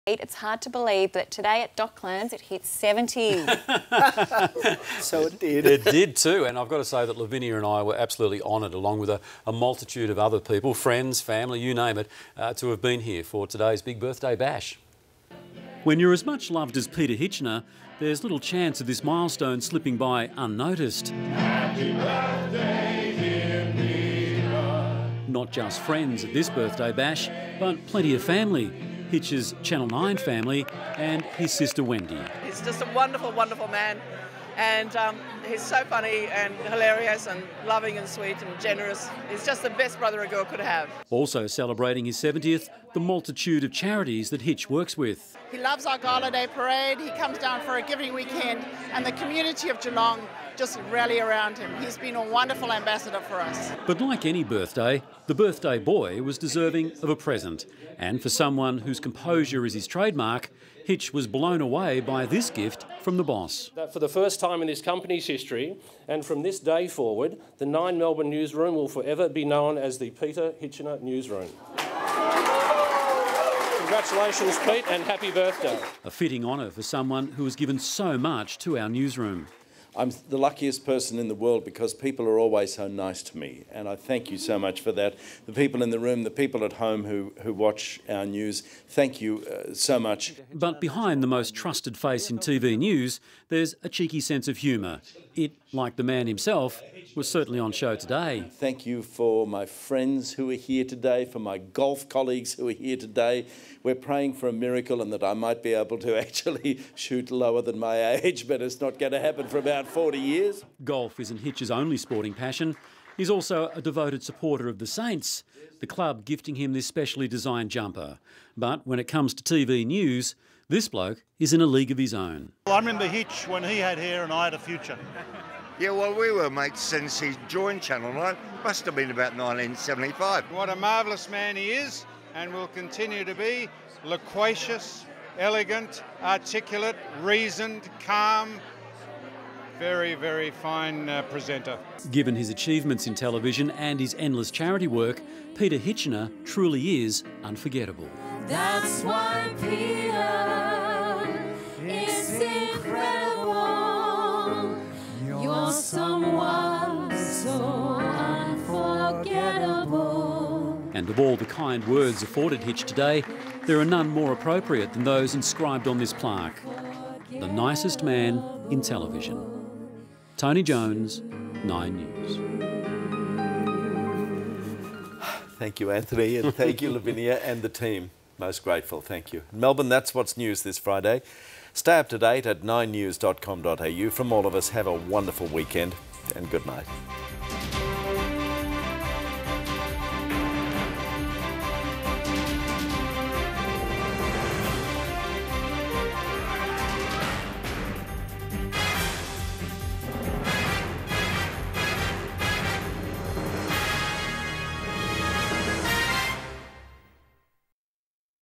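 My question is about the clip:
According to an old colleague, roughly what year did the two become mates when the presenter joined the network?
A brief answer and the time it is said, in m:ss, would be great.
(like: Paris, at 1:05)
1975, at 2:09.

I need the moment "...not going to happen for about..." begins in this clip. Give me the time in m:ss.
1:48.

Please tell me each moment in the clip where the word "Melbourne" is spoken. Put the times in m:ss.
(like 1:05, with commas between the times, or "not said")
1:07, 2:59.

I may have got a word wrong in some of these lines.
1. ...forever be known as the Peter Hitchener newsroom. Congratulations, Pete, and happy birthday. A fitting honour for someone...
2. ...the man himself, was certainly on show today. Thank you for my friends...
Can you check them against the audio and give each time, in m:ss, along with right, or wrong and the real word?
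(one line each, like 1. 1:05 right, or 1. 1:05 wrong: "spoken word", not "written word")
1. 1:08 right
2. 1:35 right.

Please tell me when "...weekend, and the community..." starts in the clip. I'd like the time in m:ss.
0:48.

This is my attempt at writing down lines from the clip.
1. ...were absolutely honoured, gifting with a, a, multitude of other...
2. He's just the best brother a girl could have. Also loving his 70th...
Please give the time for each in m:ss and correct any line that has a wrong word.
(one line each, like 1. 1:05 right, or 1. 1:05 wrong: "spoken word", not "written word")
1. 0:07 wrong: "along", not "gifting"
2. 0:39 wrong: "celebrating", not "loving".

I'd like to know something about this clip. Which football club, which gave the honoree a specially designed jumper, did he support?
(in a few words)
the Saints.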